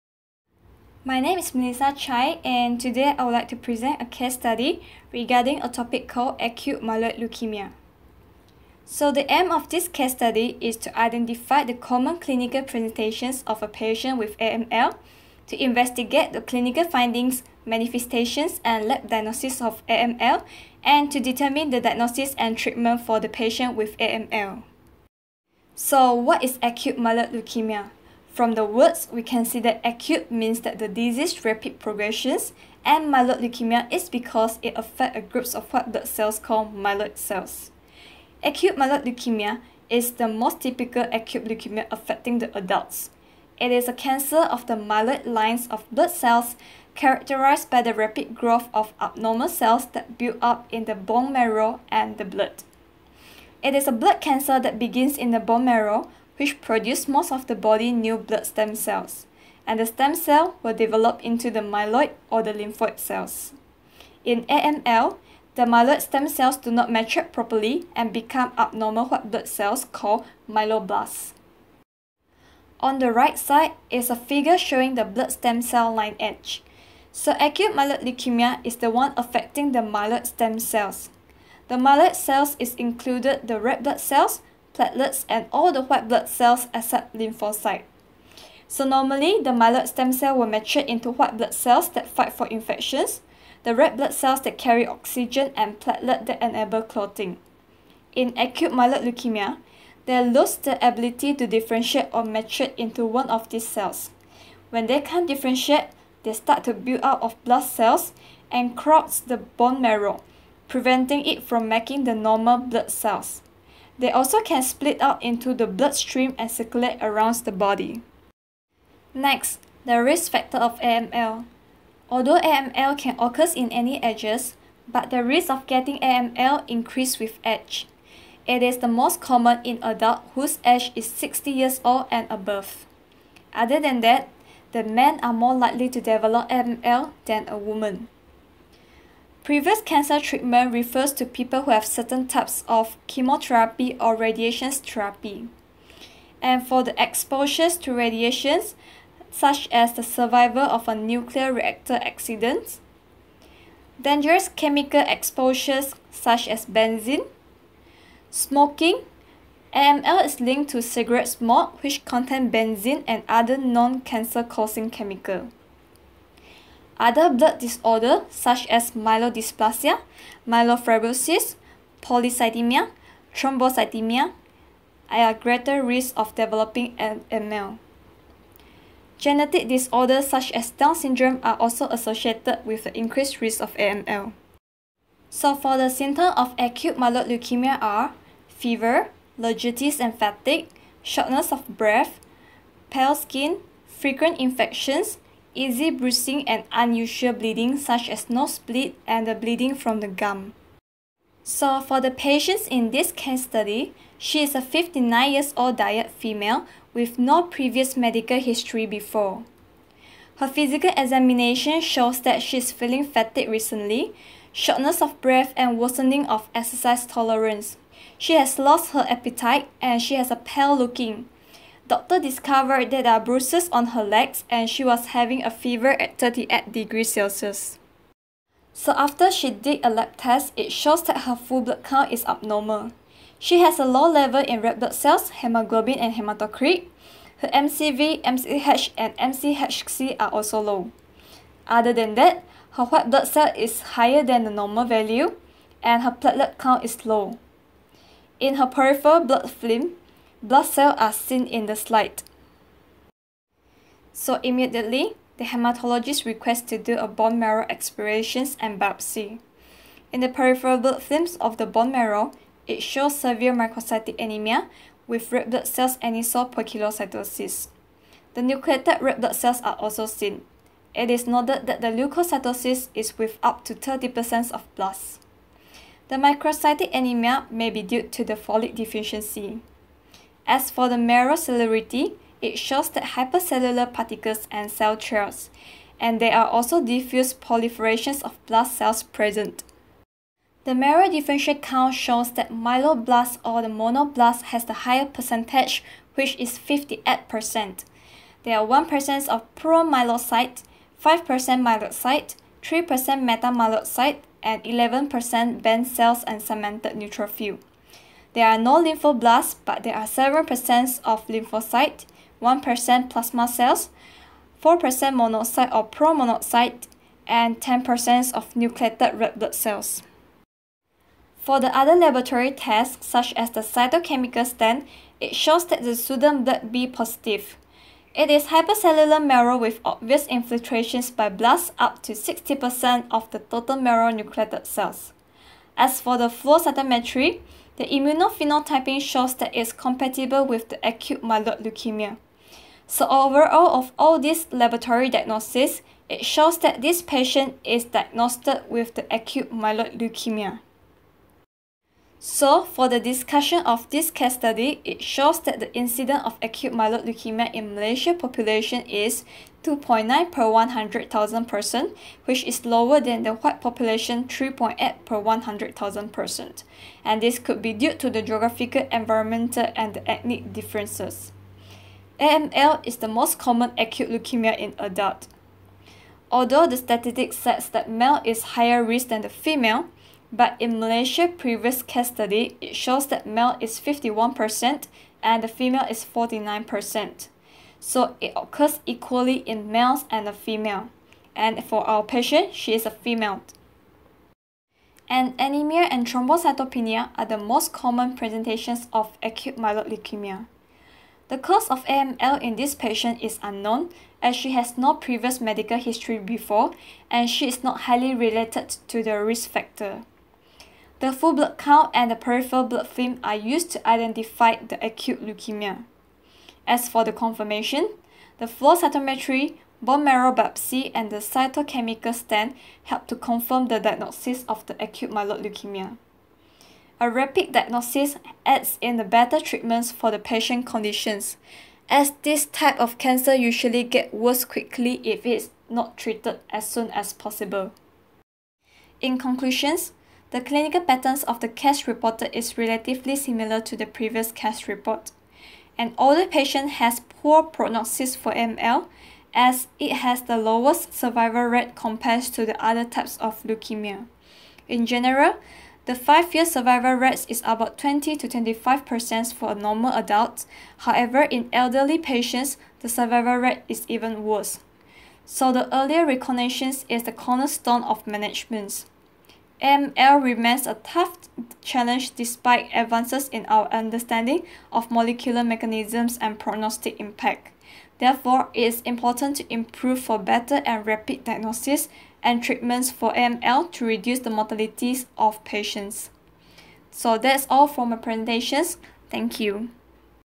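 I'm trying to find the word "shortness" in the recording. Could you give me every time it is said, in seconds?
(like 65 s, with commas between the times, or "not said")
191 s, 214 s.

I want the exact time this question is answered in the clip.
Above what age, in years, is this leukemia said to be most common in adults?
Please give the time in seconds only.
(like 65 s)
131 s.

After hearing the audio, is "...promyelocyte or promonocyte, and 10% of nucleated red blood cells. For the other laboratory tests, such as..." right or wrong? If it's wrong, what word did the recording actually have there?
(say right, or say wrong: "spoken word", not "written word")
wrong: "monocyte", not "promyelocyte".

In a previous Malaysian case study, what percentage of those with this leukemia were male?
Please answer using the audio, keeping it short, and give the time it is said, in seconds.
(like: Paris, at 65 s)
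51%, at 383 s.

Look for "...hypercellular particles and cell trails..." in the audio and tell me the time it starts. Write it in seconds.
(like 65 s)
283 s.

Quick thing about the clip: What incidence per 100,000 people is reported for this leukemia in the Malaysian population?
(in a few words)
2.9.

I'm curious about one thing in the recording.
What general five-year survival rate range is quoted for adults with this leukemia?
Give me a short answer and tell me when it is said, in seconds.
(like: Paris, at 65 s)
20 to 25%, at 457 s.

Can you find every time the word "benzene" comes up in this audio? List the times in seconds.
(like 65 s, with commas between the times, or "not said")
156 s, 162 s.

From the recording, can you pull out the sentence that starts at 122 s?
Although AML can occur in any ages, but the risk of getting AML increases with age.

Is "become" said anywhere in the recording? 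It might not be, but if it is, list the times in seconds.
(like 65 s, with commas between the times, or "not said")
68 s.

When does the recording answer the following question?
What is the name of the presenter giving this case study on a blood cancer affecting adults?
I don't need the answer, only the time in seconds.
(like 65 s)
1 s.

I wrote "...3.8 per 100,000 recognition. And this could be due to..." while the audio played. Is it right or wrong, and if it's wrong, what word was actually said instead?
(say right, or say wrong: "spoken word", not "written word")
wrong: "person", not "recognition".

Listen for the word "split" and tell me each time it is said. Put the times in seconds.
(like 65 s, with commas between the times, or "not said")
114 s.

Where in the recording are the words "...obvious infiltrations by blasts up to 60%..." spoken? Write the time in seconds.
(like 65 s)
329 s.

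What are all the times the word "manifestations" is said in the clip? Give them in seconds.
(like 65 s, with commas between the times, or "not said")
17 s.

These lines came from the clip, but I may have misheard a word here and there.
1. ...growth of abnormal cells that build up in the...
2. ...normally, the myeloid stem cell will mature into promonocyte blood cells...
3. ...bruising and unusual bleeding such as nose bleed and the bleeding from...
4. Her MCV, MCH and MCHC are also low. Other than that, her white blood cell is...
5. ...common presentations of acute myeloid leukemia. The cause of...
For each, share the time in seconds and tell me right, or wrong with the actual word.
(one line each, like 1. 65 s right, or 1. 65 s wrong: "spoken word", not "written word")
1. 48 s right
2. 88 s wrong: "white", not "promonocyte"
3. 195 s right
4. 237 s right
5. 397 s right.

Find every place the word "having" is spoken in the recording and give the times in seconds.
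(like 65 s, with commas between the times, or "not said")
225 s.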